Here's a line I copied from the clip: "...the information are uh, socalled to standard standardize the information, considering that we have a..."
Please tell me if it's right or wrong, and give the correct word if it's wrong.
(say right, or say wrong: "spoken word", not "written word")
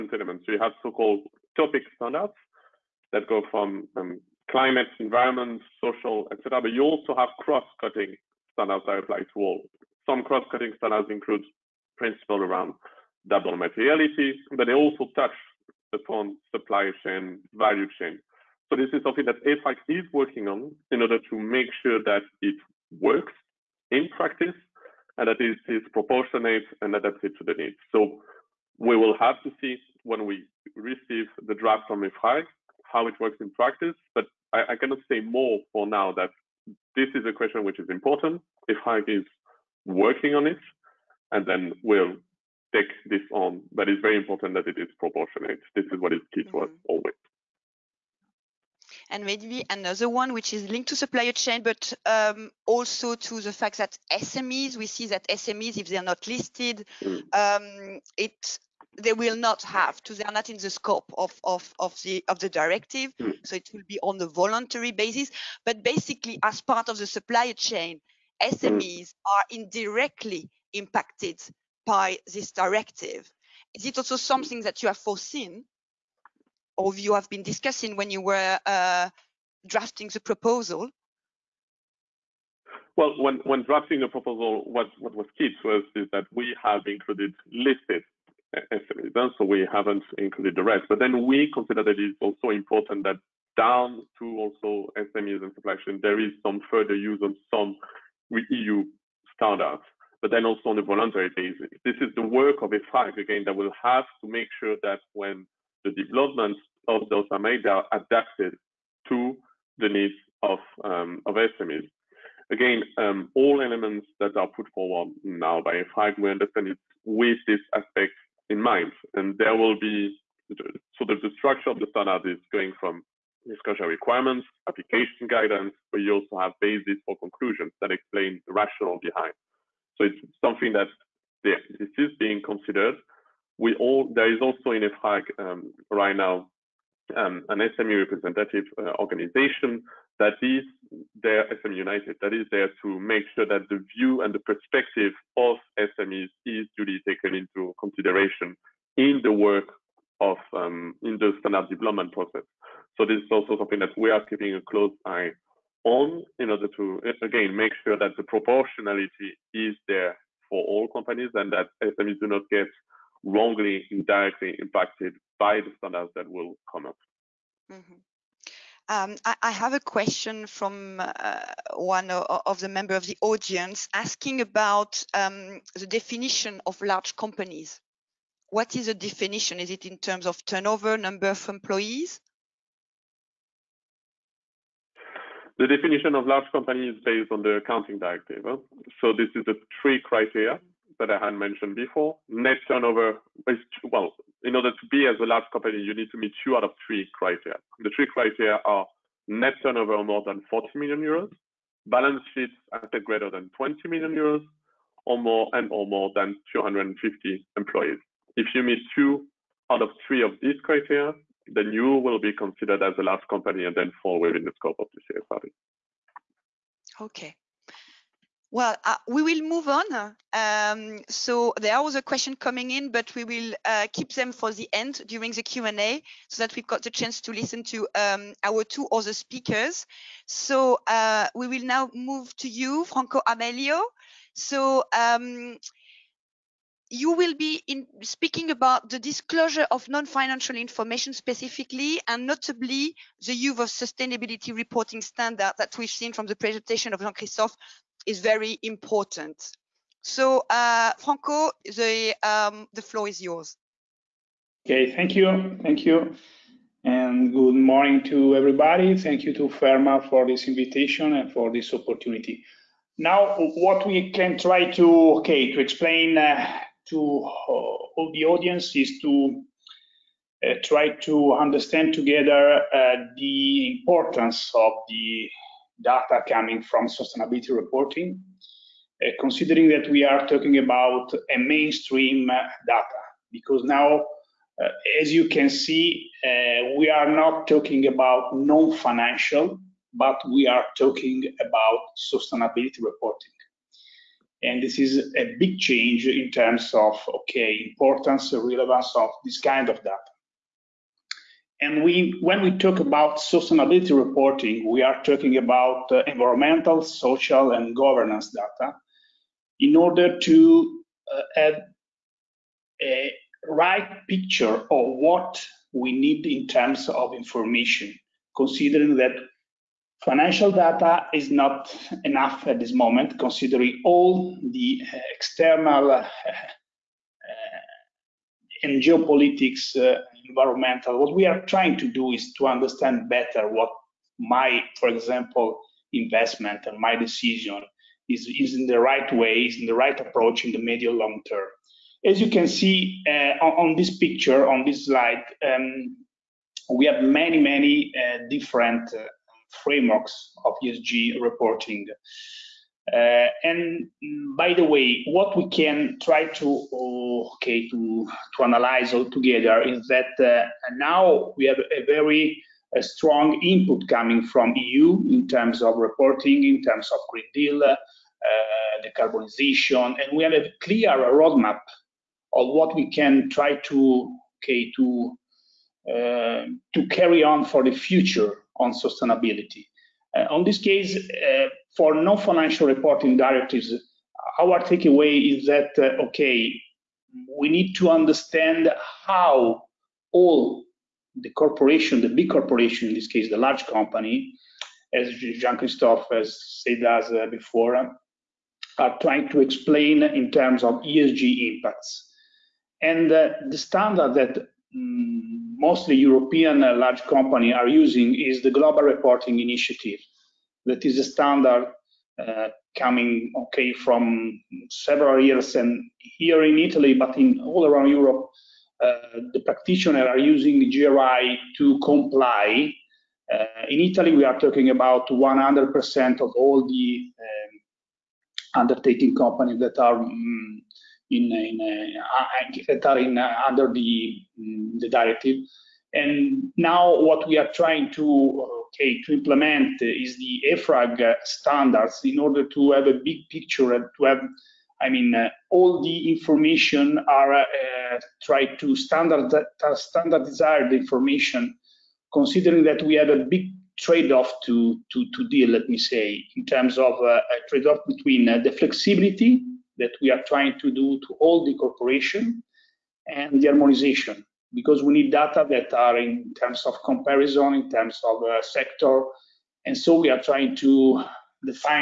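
wrong: "tried", not "socalled".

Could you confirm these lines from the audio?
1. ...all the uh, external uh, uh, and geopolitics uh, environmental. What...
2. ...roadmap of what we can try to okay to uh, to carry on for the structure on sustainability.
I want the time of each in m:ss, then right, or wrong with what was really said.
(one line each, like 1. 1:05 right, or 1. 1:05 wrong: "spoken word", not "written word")
1. 5:23 right
2. 6:10 wrong: "future", not "structure".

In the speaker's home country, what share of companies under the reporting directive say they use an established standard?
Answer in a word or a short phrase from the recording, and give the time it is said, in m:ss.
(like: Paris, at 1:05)
100%, at 7:05.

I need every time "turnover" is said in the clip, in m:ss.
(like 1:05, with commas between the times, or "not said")
3:00, 3:12, 3:19.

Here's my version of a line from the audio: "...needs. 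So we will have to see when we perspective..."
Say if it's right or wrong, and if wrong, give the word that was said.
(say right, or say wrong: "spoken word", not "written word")
wrong: "receive", not "perspective".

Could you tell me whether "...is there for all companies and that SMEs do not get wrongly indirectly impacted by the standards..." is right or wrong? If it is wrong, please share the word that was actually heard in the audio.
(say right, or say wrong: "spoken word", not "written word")
right.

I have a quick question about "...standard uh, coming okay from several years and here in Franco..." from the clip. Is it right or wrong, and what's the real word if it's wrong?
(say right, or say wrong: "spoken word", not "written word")
wrong: "Italy", not "Franco".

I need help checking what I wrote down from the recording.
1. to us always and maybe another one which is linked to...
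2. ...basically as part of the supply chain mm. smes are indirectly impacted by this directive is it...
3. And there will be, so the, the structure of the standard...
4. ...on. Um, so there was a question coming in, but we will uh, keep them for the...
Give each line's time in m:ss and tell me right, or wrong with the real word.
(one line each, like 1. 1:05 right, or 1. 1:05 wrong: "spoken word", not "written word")
1. 0:46 right
2. 1:05 right
3. 1:59 right
4. 3:39 right.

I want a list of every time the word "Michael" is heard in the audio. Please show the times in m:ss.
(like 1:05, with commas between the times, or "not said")
not said.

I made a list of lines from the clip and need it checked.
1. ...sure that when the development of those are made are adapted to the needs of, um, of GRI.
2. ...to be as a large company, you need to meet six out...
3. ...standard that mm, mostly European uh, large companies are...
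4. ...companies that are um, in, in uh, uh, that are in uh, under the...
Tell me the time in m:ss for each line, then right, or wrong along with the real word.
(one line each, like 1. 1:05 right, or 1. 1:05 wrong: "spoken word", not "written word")
1. 1:44 wrong: "SMEs", not "GRI"
2. 3:14 wrong: "two", not "six"
3. 6:43 right
4. 7:09 right.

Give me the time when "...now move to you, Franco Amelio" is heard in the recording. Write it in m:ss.
3:51.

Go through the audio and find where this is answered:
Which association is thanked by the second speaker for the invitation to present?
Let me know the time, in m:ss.
4:19.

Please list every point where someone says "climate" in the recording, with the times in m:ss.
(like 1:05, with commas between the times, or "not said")
0:04.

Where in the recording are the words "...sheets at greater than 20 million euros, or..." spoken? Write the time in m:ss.
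3:22.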